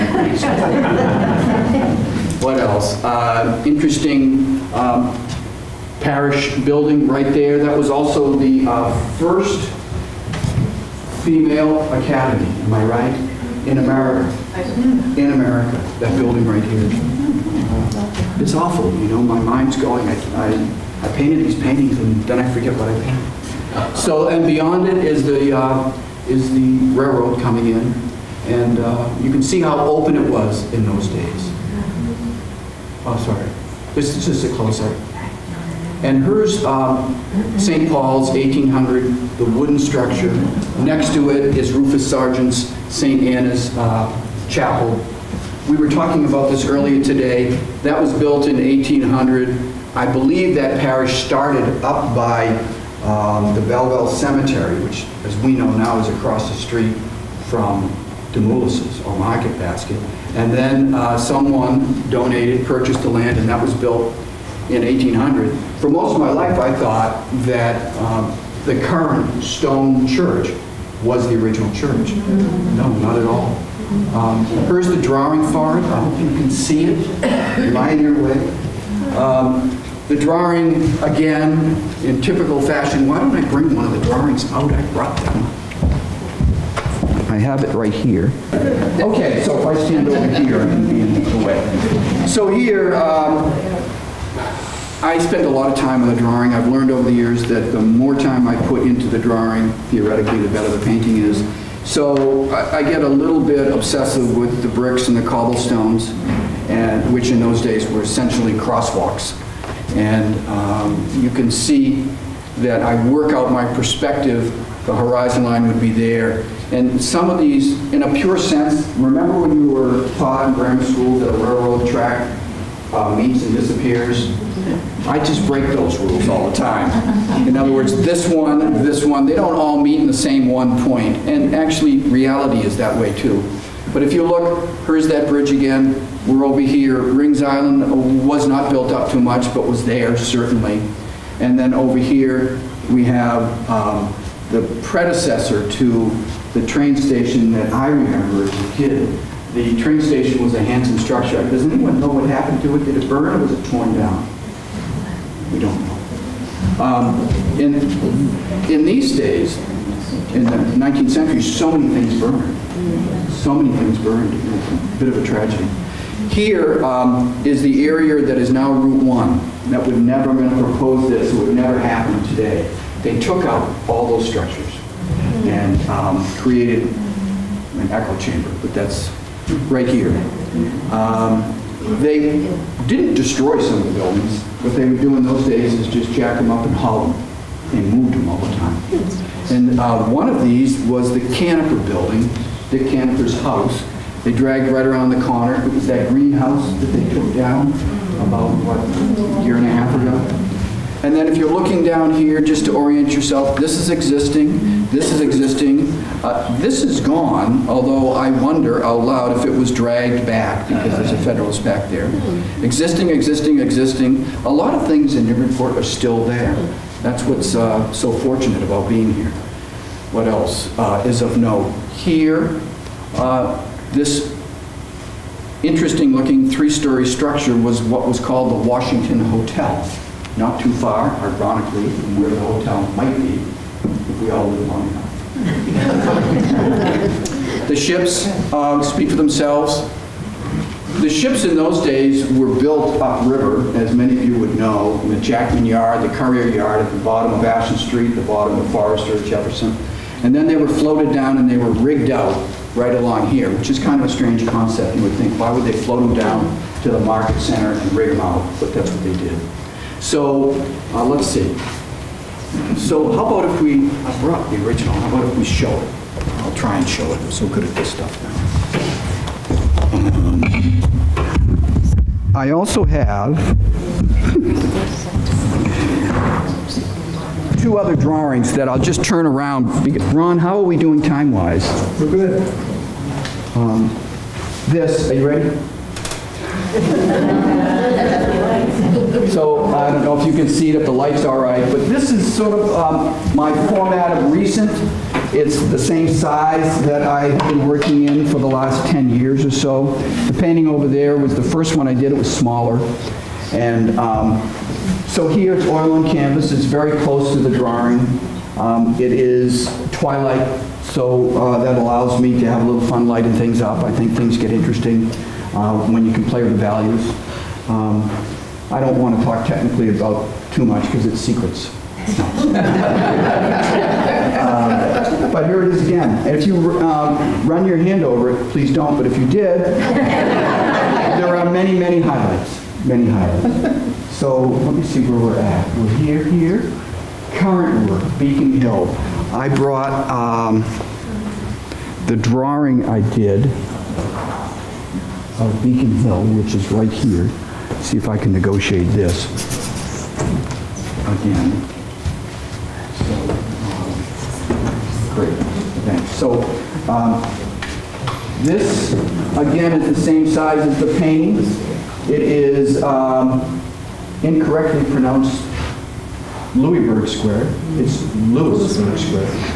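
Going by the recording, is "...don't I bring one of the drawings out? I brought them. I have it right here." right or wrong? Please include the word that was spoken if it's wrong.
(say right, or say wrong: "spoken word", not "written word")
right.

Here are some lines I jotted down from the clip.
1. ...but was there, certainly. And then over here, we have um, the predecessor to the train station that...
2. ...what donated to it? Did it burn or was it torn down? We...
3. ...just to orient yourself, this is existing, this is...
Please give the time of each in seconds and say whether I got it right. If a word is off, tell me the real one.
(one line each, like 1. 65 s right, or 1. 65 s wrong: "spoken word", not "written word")
1. 139 s right
2. 152 s wrong: "happened", not "donated"
3. 202 s right.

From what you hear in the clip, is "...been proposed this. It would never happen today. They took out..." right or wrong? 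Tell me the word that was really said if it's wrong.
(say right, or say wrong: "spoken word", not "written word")
right.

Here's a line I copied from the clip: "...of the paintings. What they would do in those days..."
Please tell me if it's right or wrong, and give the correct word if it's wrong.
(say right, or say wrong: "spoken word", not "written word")
wrong: "buildings", not "paintings".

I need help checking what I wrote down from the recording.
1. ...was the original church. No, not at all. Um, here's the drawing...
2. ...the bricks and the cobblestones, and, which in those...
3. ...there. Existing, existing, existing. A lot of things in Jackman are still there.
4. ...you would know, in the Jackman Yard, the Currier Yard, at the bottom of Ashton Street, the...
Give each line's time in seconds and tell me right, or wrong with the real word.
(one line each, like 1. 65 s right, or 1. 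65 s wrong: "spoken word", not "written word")
1. 71 s right
2. 104 s right
3. 211 s wrong: "Newburyport", not "Jackman"
4. 244 s right.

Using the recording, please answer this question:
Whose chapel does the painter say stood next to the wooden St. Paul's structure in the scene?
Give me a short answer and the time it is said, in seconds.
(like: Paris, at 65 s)
Rufus Sargent's, at 41 s.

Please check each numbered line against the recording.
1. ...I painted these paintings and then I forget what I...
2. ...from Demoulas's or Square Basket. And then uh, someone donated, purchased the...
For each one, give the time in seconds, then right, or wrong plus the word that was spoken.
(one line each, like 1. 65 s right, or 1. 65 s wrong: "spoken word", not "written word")
1. 21 s right
2. 57 s wrong: "Market", not "Square".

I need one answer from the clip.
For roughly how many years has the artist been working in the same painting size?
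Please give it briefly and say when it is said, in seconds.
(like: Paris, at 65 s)
10, at 298 s.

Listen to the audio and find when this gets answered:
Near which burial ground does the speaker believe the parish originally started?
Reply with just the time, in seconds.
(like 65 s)
53 s.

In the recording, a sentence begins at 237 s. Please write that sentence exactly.
the ships uh, speak for themselves.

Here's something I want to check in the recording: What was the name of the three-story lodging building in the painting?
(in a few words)
Washington Hotel.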